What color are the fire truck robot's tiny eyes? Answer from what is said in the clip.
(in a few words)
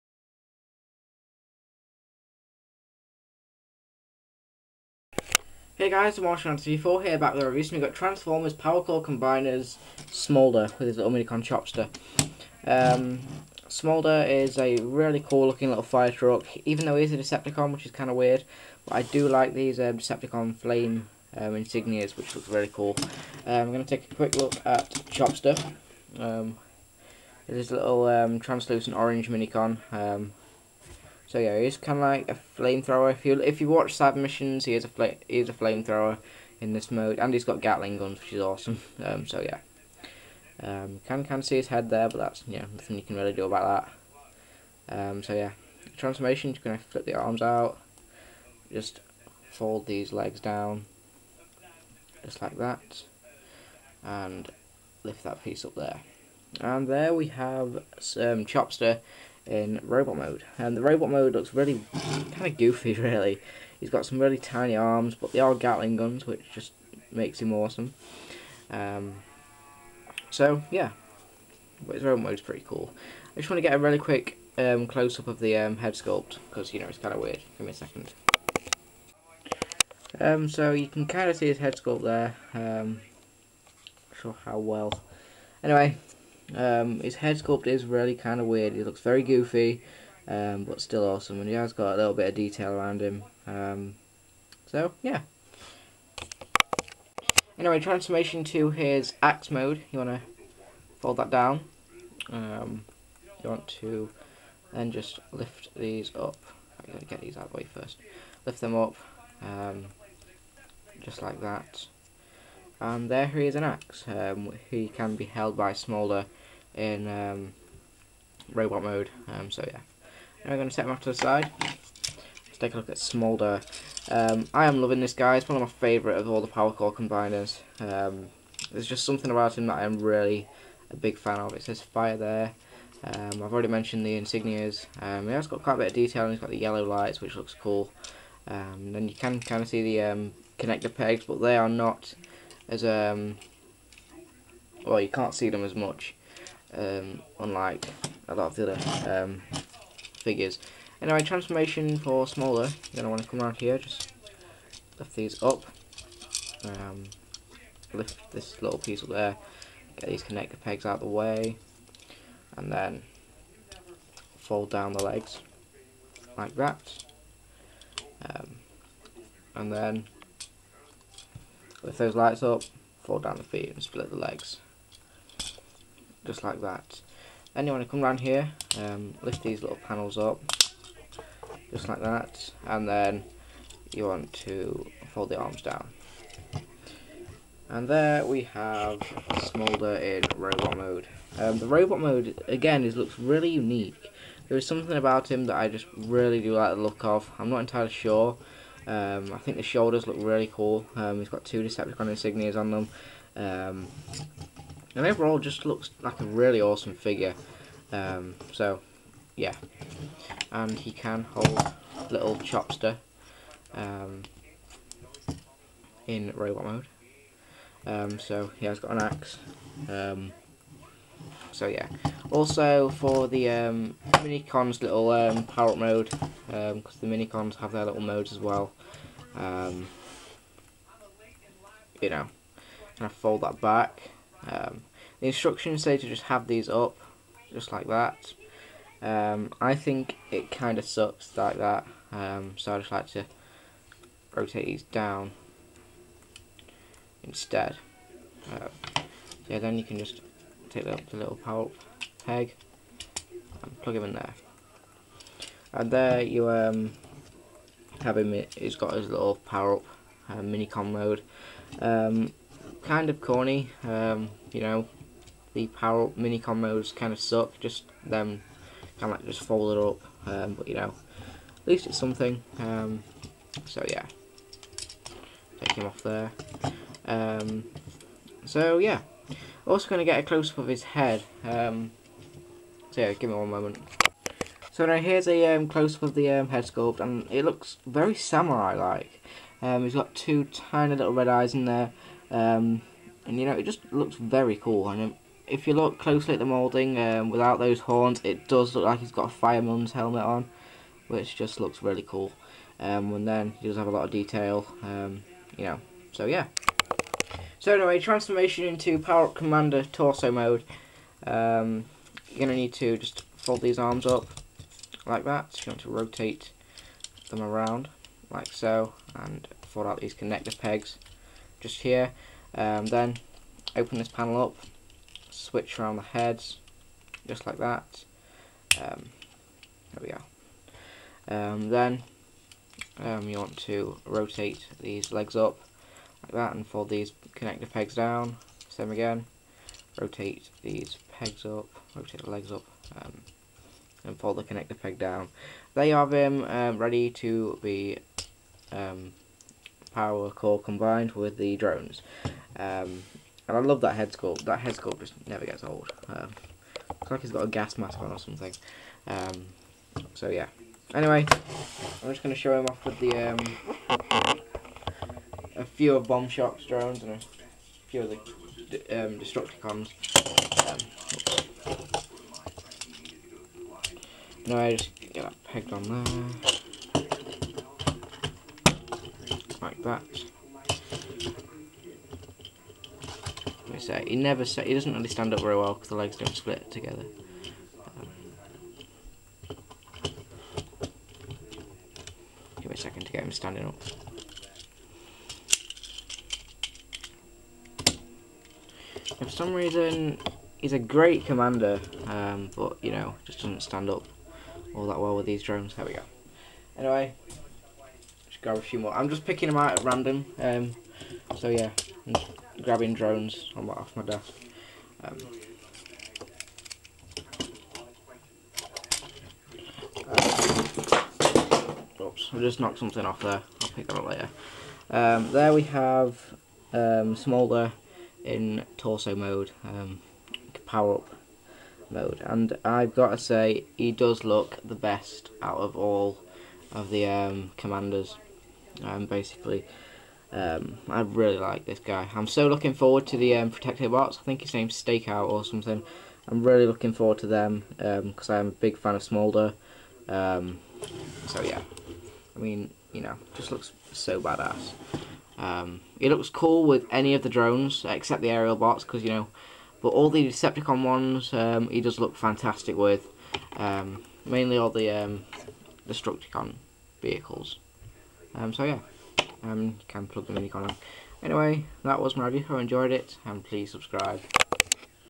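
red.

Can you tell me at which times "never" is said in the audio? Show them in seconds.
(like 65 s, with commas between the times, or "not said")
355 s, 384 s.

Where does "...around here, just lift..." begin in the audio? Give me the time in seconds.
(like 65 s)
153 s.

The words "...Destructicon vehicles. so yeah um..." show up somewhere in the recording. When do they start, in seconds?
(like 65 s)
465 s.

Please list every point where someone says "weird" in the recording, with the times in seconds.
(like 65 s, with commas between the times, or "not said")
18 s, 77 s, 88 s.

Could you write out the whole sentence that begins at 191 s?
Um, the robot mode, again, is looks really unique.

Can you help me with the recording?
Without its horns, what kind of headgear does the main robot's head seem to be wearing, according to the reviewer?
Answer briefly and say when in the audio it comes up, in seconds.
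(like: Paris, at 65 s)
fireman's helmet, at 299 s.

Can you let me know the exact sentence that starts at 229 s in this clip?
you know, kind of fold that back.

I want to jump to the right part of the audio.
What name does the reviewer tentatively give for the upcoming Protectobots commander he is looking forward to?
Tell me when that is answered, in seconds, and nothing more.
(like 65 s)
444 s.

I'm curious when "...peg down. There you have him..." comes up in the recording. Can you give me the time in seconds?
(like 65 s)
344 s.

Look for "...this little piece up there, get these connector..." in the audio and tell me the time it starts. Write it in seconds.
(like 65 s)
158 s.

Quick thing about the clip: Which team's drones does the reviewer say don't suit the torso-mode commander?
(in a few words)
Aerialbots.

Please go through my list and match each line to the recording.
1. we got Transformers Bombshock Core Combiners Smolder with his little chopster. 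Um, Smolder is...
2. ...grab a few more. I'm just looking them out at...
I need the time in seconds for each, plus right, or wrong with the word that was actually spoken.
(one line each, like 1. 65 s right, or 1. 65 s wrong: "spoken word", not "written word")
1. 7 s wrong: "Power", not "Bombshock"
2. 408 s wrong: "picking", not "looking".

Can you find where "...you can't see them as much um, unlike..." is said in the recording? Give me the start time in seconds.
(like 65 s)
144 s.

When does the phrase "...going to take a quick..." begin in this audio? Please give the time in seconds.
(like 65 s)
23 s.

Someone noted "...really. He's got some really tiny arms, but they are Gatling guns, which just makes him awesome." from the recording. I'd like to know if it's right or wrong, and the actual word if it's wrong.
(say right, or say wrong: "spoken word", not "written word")
right.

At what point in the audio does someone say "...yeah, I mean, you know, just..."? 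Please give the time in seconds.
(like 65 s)
451 s.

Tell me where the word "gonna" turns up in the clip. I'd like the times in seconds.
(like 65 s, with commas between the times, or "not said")
46 s, 312 s.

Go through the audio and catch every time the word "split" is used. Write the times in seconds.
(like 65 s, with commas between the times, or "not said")
173 s, 386 s.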